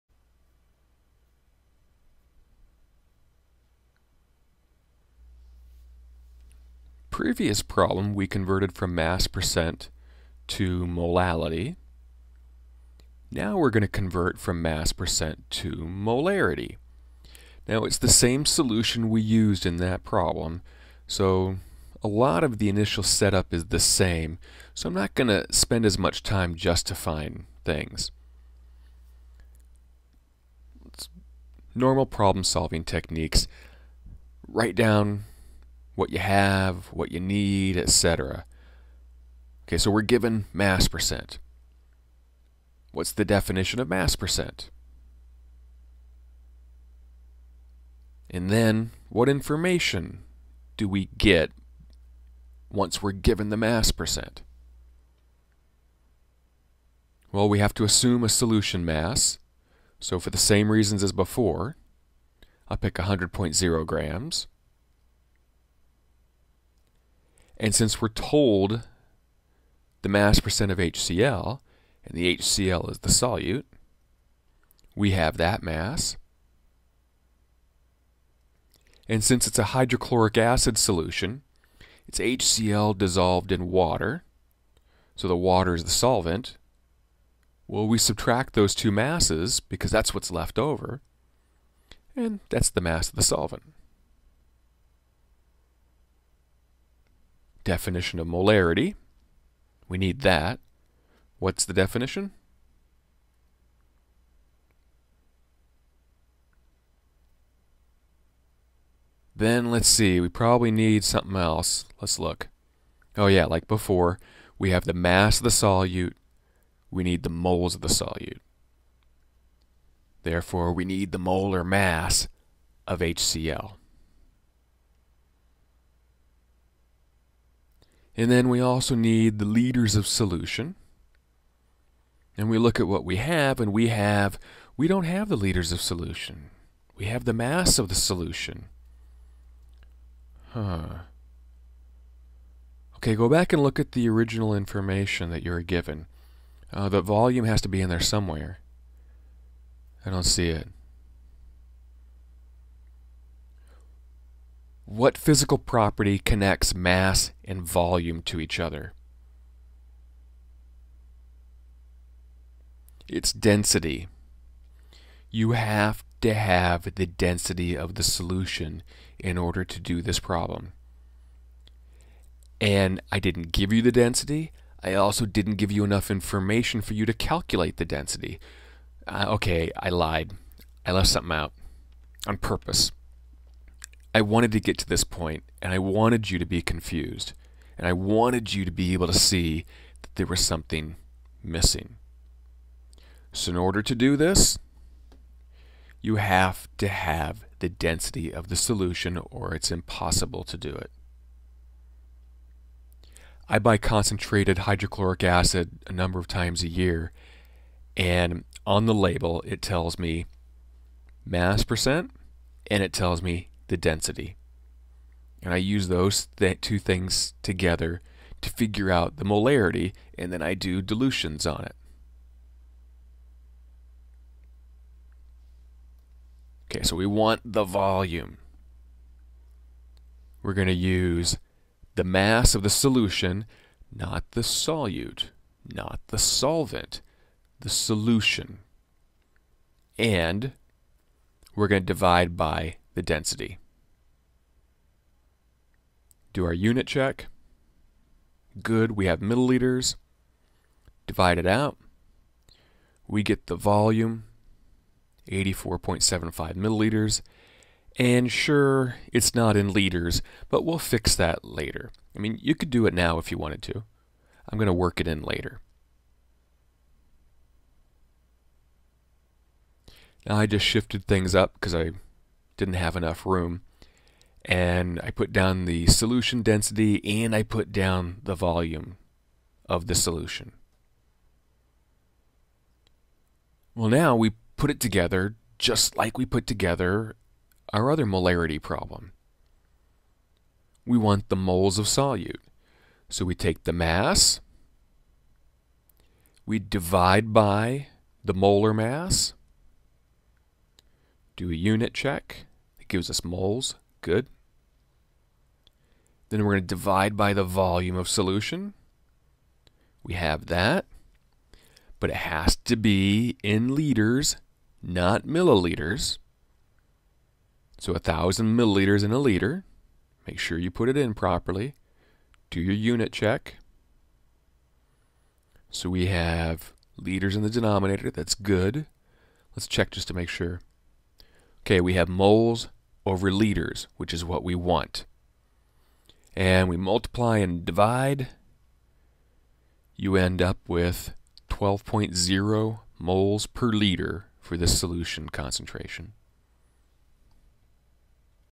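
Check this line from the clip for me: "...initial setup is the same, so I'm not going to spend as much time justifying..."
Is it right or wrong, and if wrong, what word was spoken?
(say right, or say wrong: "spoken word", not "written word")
right.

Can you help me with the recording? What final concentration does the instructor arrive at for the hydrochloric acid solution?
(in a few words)
12.0 moles per liter.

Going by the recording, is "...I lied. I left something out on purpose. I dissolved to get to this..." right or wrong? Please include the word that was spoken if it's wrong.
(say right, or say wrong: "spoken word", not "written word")
wrong: "wanted", not "dissolved".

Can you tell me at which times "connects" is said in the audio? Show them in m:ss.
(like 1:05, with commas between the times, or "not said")
2:36.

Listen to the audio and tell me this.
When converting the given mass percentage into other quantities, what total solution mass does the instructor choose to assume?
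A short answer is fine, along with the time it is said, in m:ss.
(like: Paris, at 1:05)
100.0 grams, at 1:02.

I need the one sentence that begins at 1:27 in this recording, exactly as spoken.
Well, we subtract those two masses because that's what's left over, and that's the mass of the solvent.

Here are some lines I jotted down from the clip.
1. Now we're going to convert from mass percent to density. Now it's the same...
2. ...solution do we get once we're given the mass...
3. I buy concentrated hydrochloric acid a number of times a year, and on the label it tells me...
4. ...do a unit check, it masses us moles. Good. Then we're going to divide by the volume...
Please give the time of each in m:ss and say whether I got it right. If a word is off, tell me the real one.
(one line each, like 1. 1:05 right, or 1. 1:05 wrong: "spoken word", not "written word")
1. 0:13 wrong: "molarity", not "density"
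2. 0:49 wrong: "information", not "solution"
3. 3:23 right
4. 5:01 wrong: "gives", not "masses".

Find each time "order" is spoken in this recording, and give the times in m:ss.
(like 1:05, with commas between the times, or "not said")
2:49, 3:13.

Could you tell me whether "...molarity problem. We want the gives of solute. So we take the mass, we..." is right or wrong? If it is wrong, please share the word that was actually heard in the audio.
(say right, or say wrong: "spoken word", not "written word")
wrong: "moles", not "gives".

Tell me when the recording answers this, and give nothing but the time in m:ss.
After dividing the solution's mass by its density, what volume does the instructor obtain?
4:15.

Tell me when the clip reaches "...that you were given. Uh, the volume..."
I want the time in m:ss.
2:25.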